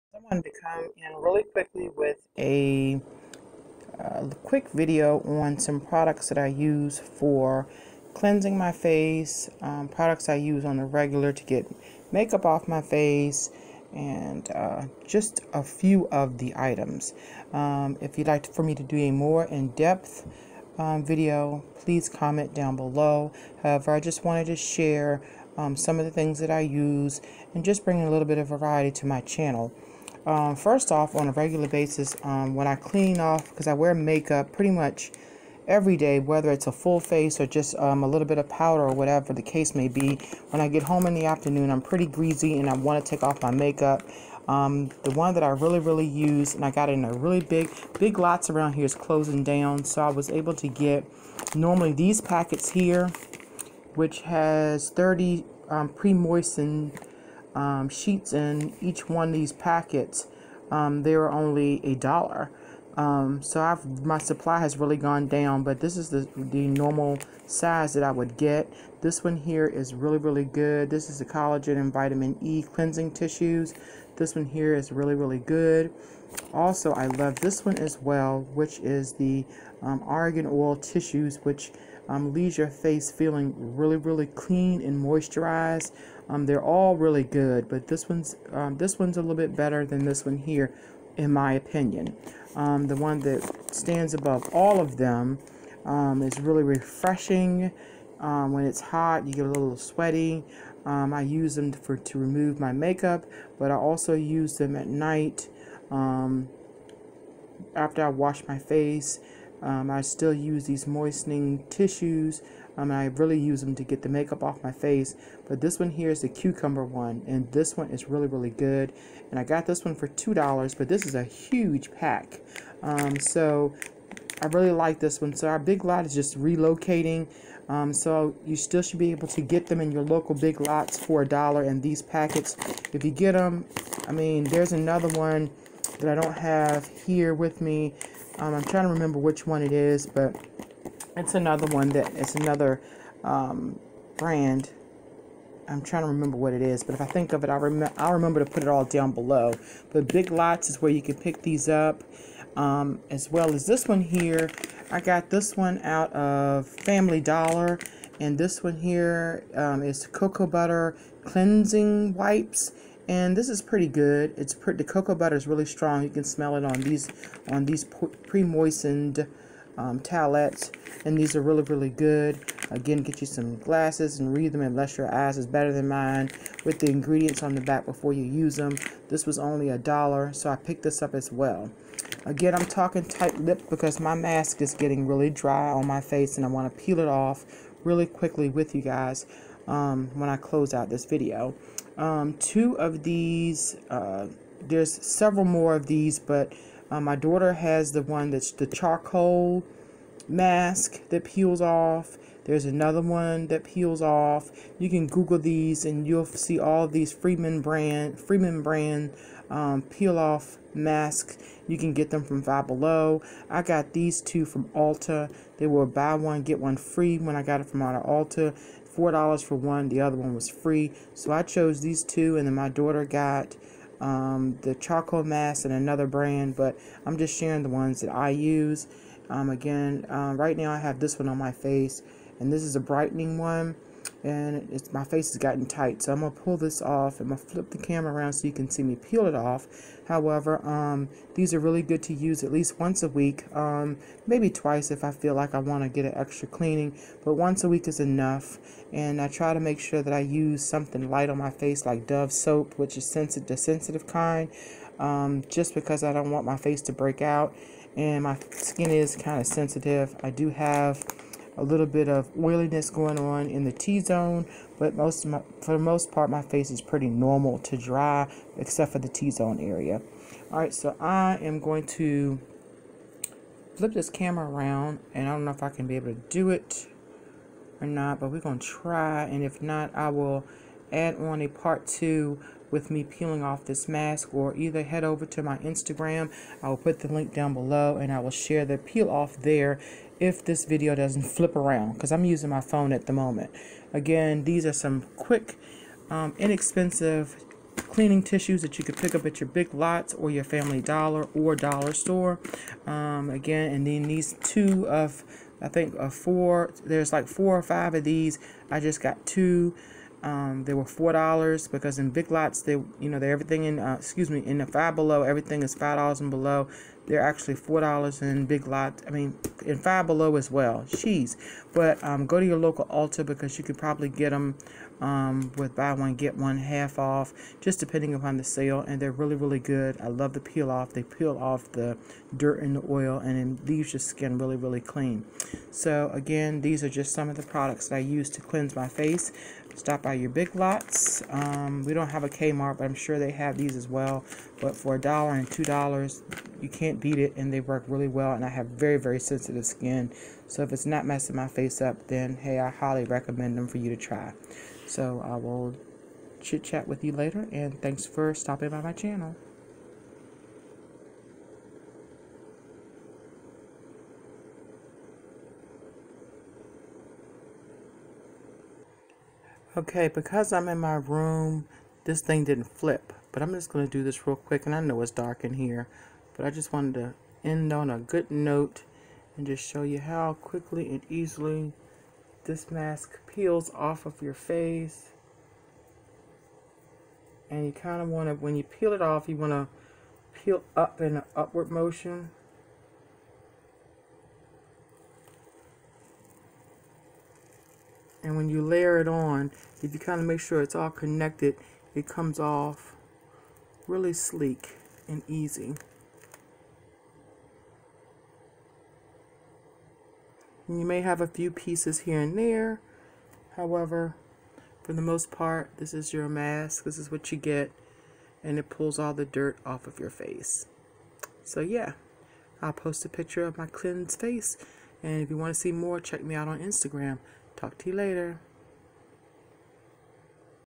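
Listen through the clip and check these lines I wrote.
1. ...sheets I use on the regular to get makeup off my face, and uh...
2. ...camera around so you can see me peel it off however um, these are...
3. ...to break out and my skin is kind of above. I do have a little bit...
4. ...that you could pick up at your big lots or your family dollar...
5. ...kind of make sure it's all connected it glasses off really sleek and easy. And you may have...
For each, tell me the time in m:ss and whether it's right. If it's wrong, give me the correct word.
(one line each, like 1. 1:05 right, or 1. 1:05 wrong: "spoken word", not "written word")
1. 0:09 wrong: "products", not "sheets"
2. 3:57 right
3. 4:16 wrong: "sensitive", not "above"
4. 4:58 right
5. 6:39 wrong: "comes", not "glasses".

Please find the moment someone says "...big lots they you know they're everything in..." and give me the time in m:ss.
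5:12.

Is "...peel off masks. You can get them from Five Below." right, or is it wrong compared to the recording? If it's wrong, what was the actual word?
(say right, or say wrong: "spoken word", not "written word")
right.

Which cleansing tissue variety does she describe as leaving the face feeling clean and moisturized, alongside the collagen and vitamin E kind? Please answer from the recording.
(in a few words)
Argan Oil.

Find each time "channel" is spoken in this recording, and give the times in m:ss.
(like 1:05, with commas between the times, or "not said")
0:29, 5:58.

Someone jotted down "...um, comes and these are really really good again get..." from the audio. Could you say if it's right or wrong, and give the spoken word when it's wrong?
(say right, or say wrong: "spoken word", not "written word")
wrong: "towelettes", not "comes".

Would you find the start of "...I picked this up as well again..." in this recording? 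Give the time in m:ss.
3:00.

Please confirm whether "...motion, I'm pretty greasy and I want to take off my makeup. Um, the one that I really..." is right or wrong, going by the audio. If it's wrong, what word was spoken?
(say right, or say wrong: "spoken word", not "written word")
wrong: "afternoon", not "motion".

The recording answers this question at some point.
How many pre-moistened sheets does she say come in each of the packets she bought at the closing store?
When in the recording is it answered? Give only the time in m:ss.
0:54.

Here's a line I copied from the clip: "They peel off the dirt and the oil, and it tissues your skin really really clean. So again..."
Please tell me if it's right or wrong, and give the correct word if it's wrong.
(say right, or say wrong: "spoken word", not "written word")
wrong: "leaves", not "tissues".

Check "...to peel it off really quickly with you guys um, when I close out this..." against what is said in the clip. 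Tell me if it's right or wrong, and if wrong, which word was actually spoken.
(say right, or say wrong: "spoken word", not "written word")
right.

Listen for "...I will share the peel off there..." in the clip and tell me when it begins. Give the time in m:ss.
4:48.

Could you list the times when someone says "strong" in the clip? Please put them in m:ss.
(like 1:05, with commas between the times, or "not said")
2:45.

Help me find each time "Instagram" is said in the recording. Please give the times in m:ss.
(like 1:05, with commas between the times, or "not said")
4:45, 7:06.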